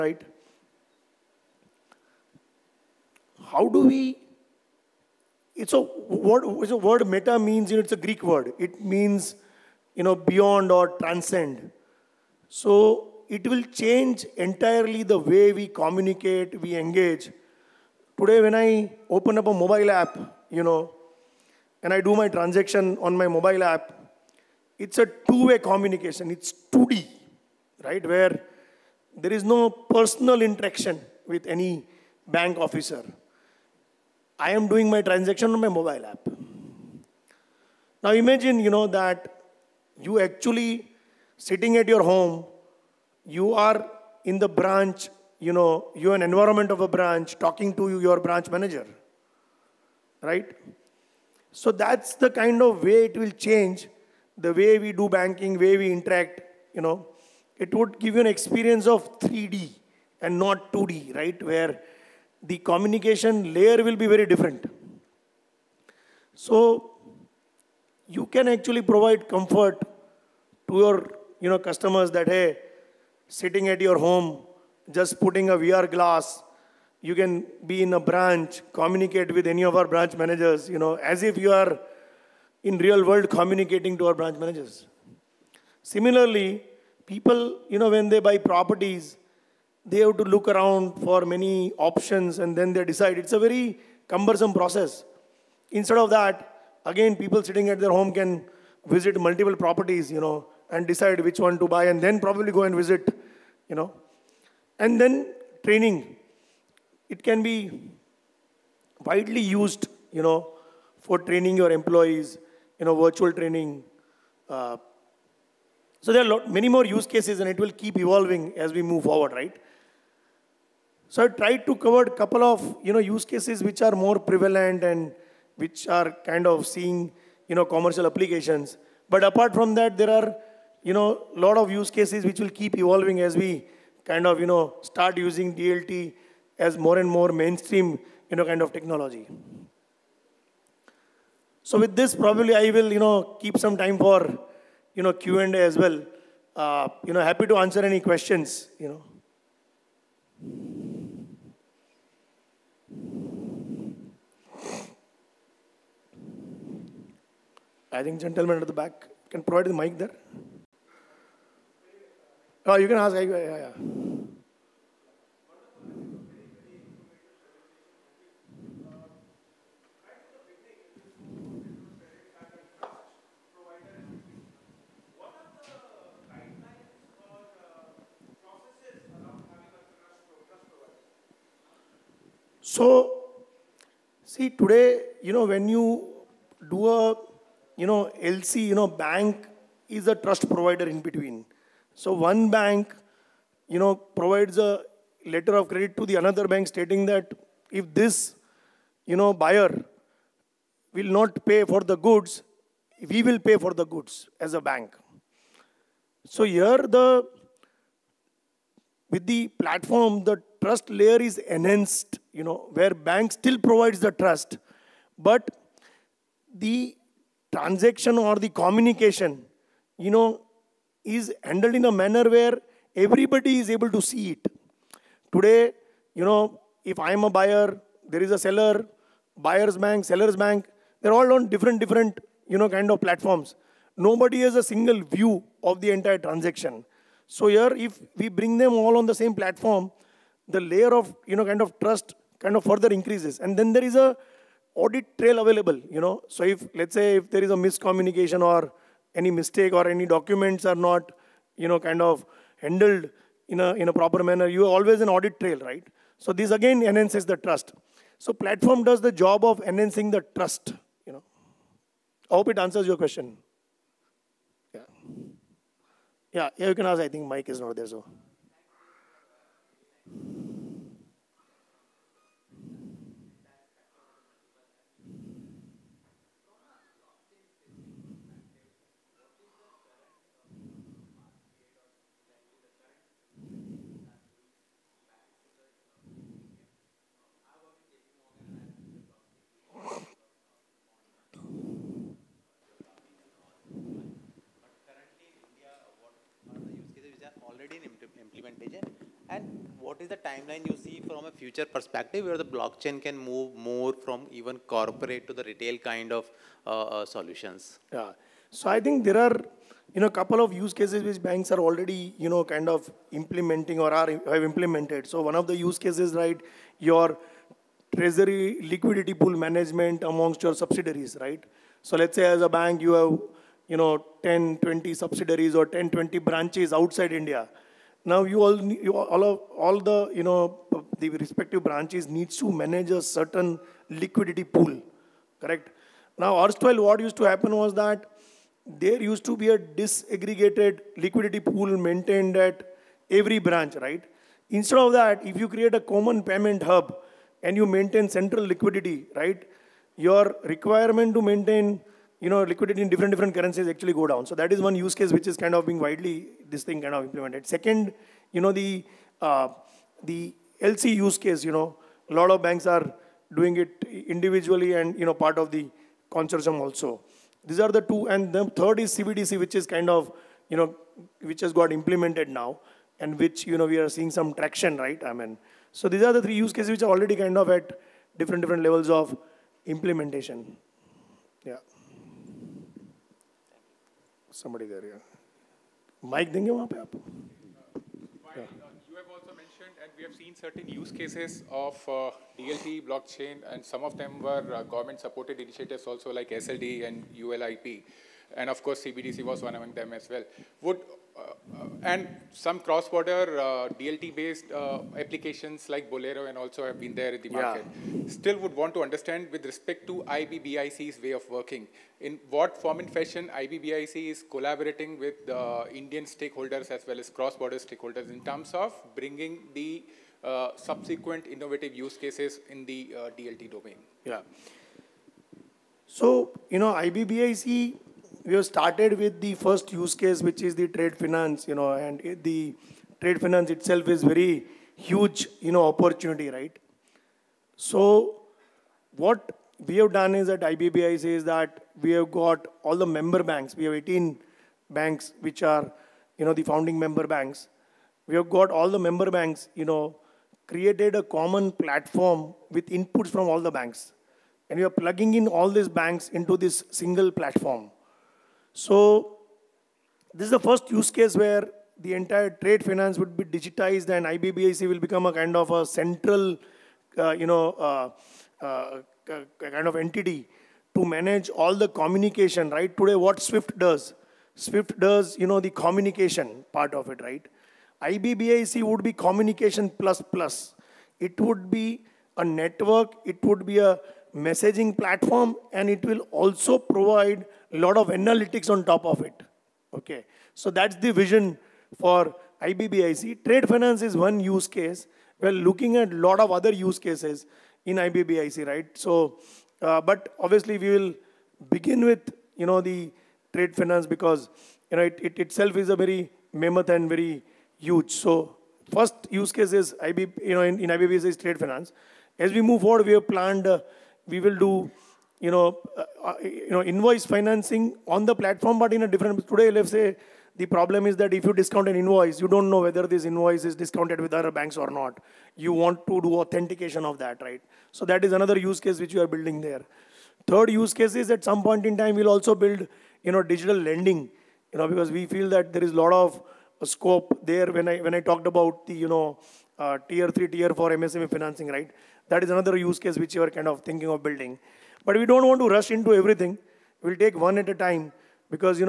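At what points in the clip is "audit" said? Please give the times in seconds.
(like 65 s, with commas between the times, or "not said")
244 s, 255 s.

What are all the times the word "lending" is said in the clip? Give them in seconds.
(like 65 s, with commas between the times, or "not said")
533 s.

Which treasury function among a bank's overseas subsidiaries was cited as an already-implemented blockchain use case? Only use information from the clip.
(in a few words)
Liquidity pool management.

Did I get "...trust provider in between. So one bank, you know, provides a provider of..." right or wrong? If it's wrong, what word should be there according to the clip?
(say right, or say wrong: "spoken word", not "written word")
wrong: "letter", not "provider".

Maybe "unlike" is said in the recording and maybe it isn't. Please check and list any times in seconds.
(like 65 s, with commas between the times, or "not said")
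not said.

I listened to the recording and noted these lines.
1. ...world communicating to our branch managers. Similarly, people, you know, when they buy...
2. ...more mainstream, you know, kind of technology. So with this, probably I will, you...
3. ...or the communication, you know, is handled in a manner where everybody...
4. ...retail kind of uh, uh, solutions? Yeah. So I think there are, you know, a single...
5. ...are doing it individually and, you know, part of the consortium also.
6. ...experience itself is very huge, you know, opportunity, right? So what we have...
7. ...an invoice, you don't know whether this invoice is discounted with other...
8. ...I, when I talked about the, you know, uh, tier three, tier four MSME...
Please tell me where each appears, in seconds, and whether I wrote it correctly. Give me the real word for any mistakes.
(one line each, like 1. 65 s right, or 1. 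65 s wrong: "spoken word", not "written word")
1. 83 s right
2. 137 s right
3. 218 s right
4. 305 s wrong: "couple", not "single"
5. 362 s right
6. 433 s wrong: "finance", not "experience"
7. 521 s right
8. 537 s right.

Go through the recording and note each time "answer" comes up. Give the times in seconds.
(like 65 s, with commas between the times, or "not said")
147 s, 262 s.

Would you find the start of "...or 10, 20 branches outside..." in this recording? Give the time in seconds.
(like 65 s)
325 s.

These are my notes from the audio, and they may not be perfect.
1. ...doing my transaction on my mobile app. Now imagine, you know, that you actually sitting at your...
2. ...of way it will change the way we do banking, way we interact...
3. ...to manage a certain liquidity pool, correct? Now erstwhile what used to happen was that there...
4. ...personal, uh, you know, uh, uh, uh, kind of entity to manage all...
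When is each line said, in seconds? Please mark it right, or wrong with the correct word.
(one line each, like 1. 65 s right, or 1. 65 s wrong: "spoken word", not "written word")
1. 34 s right
2. 52 s right
3. 332 s right
4. 465 s wrong: "central", not "personal".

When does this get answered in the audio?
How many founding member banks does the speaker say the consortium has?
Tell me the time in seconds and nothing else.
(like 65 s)
443 s.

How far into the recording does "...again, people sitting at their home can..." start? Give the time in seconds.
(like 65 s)
96 s.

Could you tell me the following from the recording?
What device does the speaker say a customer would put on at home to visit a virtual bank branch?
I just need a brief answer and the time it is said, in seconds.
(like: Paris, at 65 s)
VR glass, at 75 s.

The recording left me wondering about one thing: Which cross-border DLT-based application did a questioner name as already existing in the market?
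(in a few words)
Bolero.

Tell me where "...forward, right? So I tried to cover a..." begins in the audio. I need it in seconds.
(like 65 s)
119 s.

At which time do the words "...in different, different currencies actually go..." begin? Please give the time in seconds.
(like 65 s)
352 s.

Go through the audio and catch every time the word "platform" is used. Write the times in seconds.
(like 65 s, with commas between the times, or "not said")
209 s, 232 s, 239 s, 258 s, 451 s, 457 s, 484 s, 518 s.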